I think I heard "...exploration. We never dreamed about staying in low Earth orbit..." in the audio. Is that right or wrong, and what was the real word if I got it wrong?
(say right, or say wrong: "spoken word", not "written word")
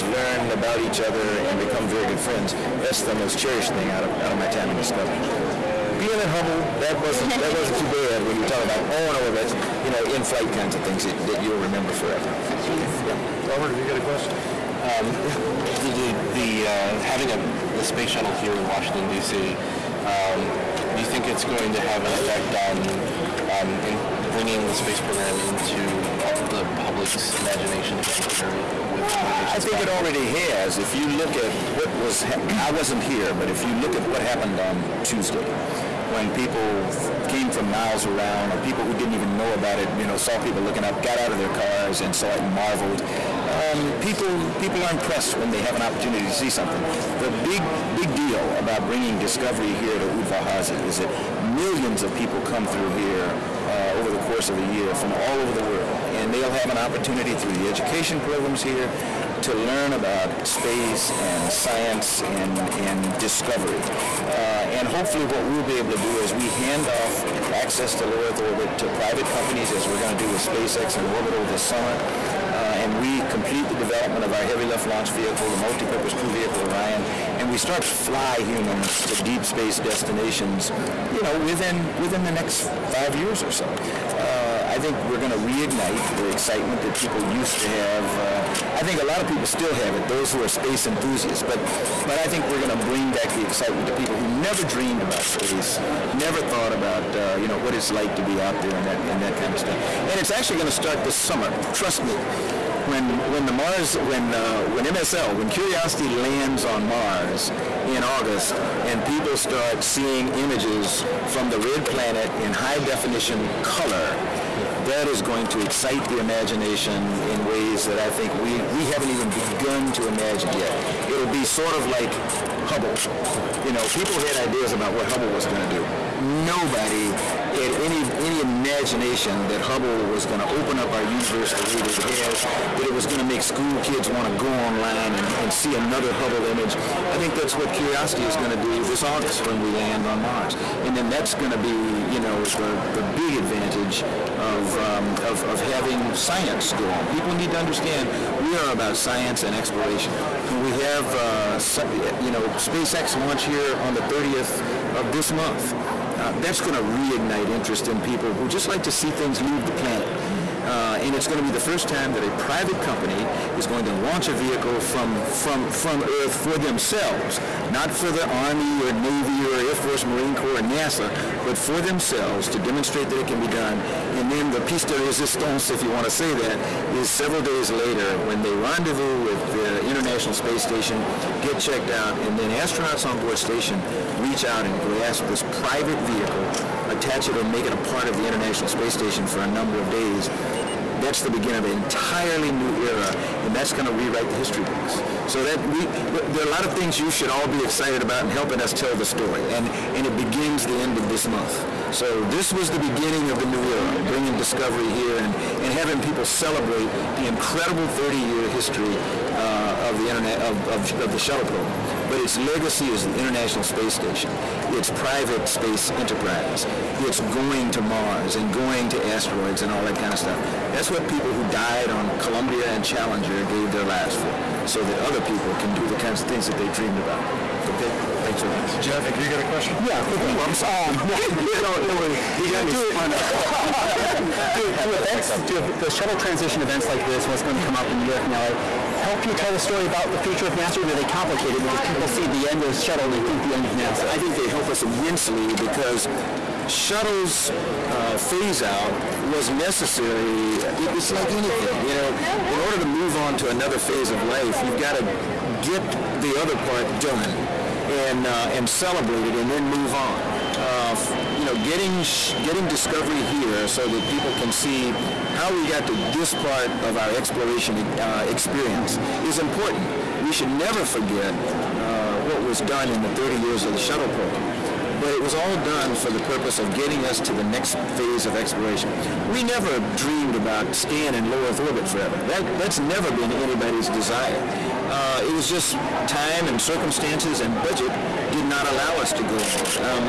right.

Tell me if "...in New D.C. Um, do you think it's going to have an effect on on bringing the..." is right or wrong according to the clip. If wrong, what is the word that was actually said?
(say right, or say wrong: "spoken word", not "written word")
wrong: "Washington", not "New".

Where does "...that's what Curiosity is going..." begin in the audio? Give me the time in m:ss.
2:17.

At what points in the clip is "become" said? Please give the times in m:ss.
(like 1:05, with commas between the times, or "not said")
0:01.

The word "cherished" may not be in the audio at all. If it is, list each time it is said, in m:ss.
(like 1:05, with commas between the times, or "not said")
0:03.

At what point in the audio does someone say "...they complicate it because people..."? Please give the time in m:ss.
4:00.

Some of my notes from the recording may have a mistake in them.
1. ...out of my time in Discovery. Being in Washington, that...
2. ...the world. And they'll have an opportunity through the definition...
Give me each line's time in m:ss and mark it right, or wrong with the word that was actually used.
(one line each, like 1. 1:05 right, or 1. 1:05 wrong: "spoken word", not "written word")
1. 0:04 wrong: "Hubble", not "Washington"
2. 0:55 wrong: "education", not "definition".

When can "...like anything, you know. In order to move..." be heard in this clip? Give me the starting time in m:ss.
4:11.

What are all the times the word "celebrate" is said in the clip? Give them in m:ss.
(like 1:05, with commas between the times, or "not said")
3:26, 4:18.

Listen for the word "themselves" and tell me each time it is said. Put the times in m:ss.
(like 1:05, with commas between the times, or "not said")
2:46, 2:51.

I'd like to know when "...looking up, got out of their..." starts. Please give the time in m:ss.
0:40.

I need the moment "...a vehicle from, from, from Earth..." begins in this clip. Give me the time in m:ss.
2:44.